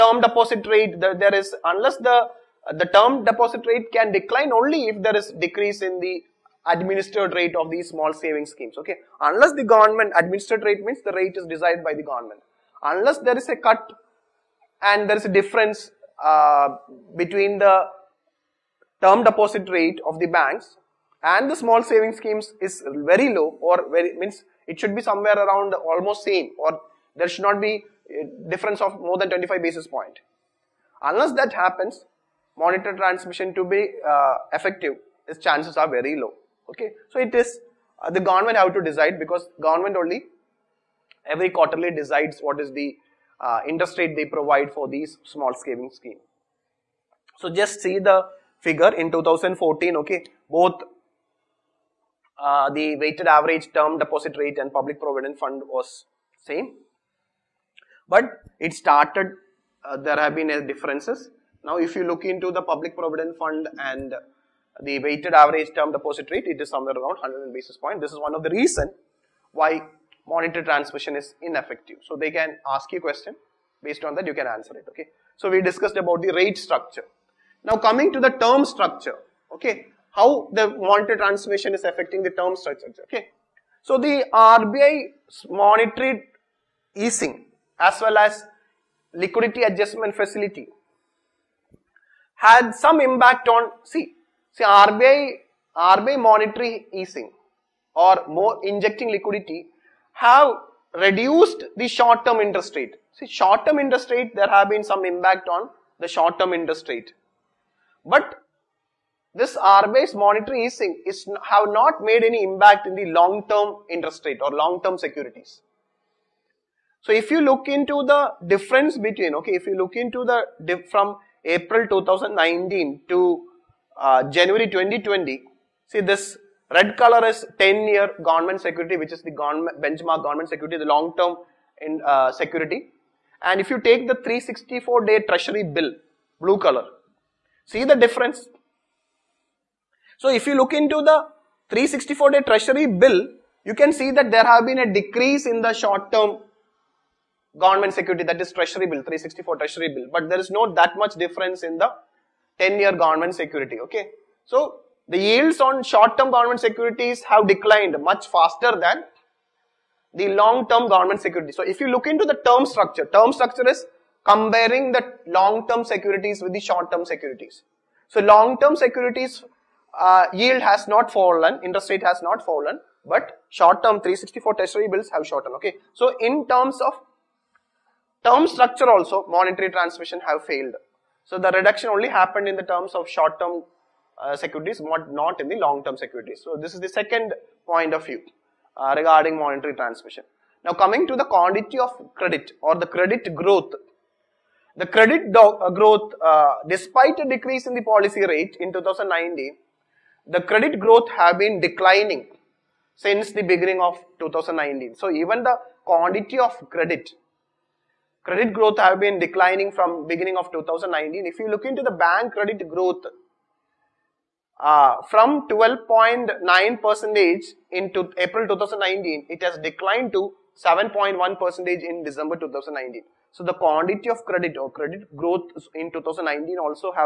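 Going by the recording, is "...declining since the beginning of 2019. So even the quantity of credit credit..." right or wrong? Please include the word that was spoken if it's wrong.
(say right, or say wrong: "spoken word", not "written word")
right.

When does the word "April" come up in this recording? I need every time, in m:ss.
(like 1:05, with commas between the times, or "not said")
2:01, 3:38.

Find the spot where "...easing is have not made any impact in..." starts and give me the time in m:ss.
1:50.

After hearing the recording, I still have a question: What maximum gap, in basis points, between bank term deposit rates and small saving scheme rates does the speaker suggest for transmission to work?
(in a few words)
25 basis points.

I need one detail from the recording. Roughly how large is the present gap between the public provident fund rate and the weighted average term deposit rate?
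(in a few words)
100 basis points.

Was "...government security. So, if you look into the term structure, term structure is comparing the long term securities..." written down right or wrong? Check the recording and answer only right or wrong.
right.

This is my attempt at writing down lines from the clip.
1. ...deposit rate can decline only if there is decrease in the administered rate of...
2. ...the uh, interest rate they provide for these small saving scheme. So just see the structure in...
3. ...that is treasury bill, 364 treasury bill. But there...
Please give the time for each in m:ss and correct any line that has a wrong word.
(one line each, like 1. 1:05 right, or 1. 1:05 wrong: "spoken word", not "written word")
1. 0:03 right
2. 0:42 wrong: "figure", not "structure"
3. 2:28 right.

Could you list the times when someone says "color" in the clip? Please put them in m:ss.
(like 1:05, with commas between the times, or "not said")
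2:06, 2:16.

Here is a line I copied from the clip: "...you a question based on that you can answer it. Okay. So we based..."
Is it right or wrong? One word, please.
wrong.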